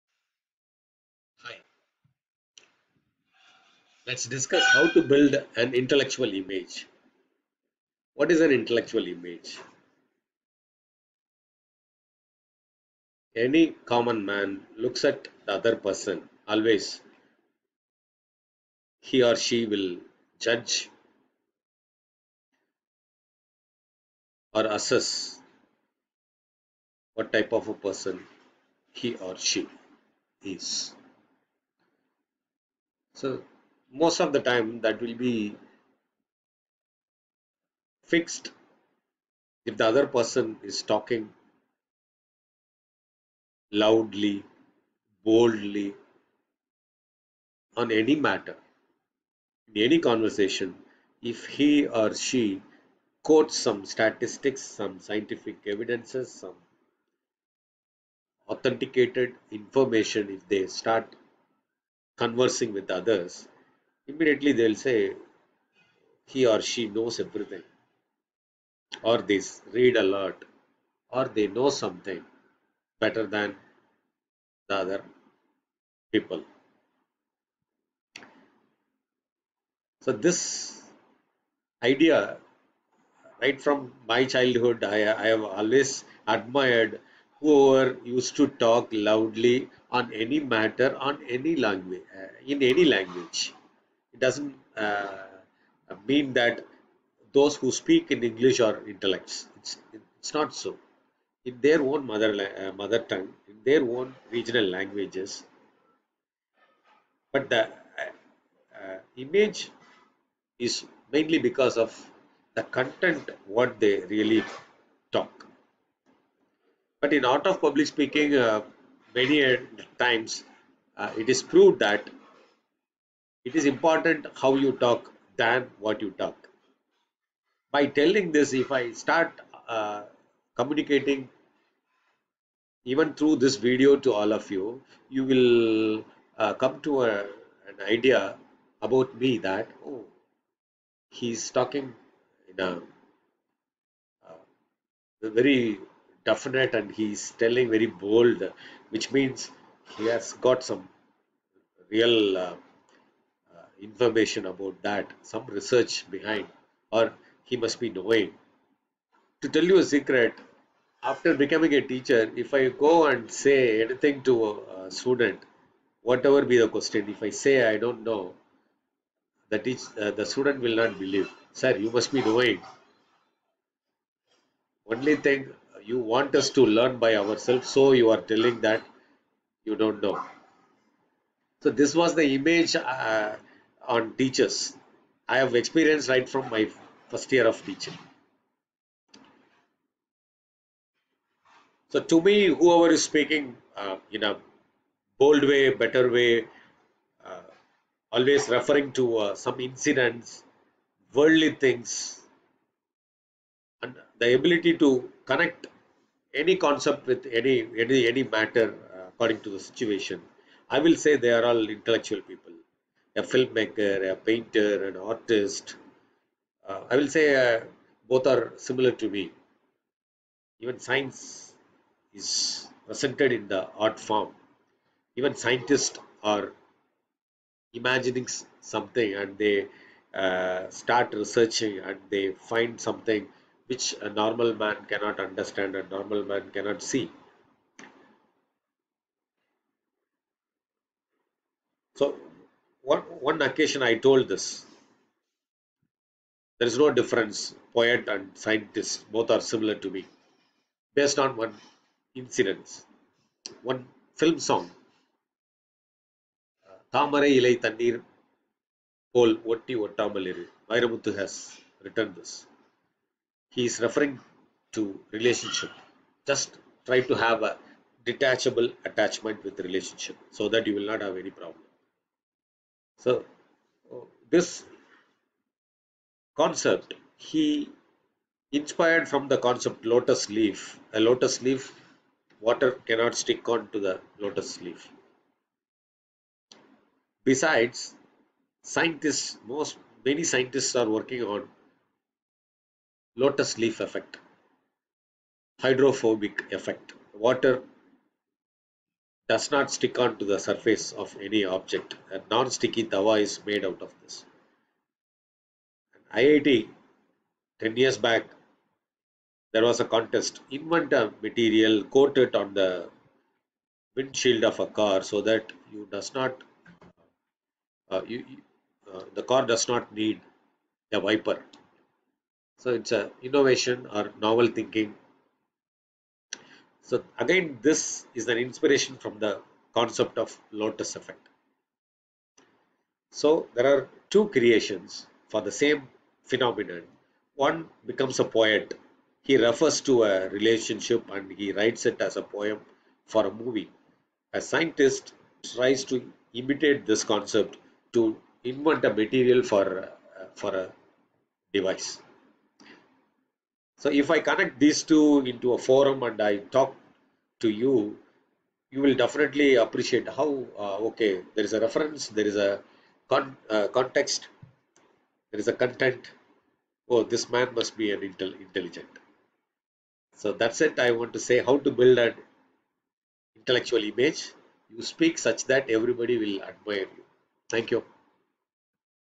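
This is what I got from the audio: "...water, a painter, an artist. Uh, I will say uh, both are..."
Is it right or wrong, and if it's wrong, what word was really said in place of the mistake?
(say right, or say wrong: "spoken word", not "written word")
wrong: "filmmaker", not "water".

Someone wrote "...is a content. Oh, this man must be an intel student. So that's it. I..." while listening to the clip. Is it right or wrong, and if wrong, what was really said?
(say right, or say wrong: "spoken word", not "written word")
wrong: "intelligent", not "student".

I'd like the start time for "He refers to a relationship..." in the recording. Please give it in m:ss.
5:39.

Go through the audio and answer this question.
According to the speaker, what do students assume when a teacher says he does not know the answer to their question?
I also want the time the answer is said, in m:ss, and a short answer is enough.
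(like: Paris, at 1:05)
You must be knowing, at 2:51.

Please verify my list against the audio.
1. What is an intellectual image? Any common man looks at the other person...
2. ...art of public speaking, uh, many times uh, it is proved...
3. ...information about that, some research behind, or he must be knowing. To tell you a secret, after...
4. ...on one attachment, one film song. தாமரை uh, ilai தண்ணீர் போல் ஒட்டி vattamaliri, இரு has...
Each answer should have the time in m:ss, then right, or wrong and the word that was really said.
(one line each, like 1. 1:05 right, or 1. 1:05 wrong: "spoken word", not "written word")
1. 0:08 right
2. 1:57 right
3. 2:33 right
4. 4:11 wrong: "incident", not "attachment".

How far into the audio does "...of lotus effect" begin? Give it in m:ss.
5:30.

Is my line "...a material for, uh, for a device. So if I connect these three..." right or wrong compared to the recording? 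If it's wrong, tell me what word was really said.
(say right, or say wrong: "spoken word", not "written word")
wrong: "two", not "three".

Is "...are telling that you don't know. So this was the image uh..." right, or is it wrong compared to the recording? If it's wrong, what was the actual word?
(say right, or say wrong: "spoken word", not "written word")
right.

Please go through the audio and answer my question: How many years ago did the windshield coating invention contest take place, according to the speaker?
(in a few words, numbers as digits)
10 years.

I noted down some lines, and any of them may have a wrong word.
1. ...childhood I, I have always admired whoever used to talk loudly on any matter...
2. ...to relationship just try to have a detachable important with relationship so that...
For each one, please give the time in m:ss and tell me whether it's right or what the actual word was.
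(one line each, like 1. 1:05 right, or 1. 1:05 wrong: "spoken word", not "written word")
1. 1:24 right
2. 4:24 wrong: "attachment", not "important".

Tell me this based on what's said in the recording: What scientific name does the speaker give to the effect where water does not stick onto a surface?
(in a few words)
Hydrophobic effect.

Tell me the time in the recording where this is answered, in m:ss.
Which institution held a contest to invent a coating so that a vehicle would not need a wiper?
5:06.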